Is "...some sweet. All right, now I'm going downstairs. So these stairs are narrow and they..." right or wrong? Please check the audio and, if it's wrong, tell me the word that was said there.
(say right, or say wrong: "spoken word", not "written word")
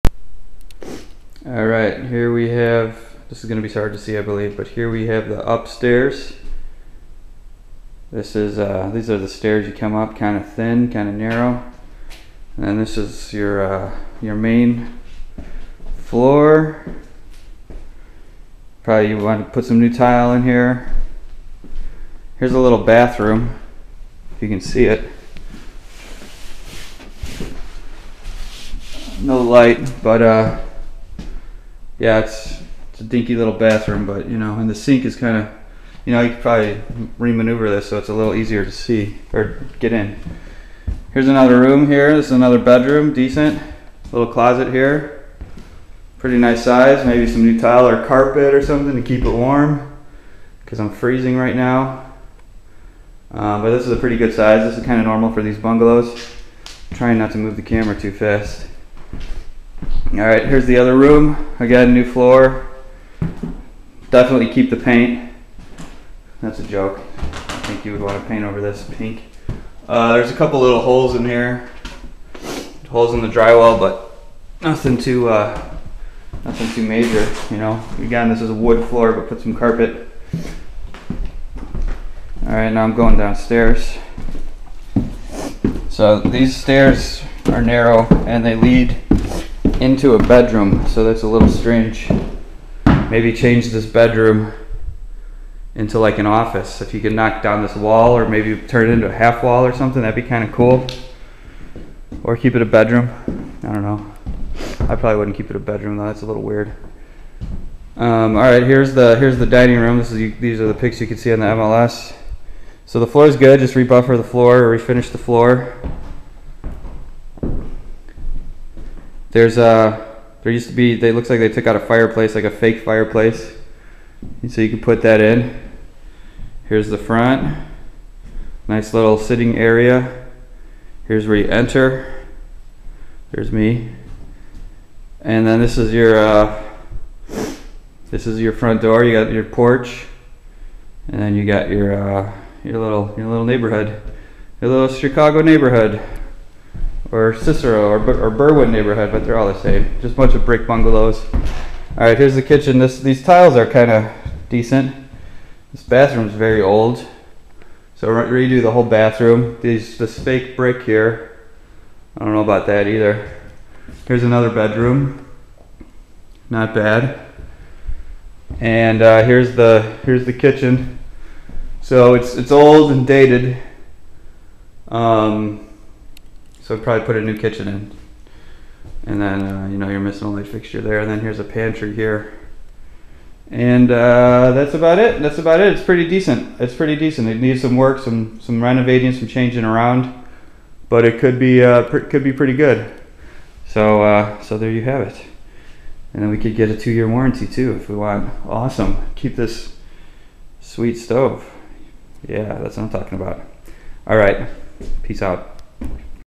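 wrong: "carpet", not "sweet".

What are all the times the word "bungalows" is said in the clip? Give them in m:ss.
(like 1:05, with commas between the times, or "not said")
0:55, 2:30.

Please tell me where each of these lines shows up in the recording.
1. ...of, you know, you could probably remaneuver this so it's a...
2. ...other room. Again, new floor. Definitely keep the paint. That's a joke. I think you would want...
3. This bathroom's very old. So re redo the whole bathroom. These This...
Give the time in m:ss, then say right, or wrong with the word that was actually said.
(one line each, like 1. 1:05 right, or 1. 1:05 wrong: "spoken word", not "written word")
1. 0:35 right
2. 1:00 right
3. 2:35 right.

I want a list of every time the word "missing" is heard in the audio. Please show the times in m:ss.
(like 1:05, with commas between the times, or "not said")
2:59.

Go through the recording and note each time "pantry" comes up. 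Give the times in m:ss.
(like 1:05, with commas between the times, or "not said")
3:01.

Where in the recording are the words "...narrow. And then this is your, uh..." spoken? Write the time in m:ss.
0:11.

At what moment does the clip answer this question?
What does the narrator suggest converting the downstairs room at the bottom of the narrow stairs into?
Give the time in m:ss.
1:36.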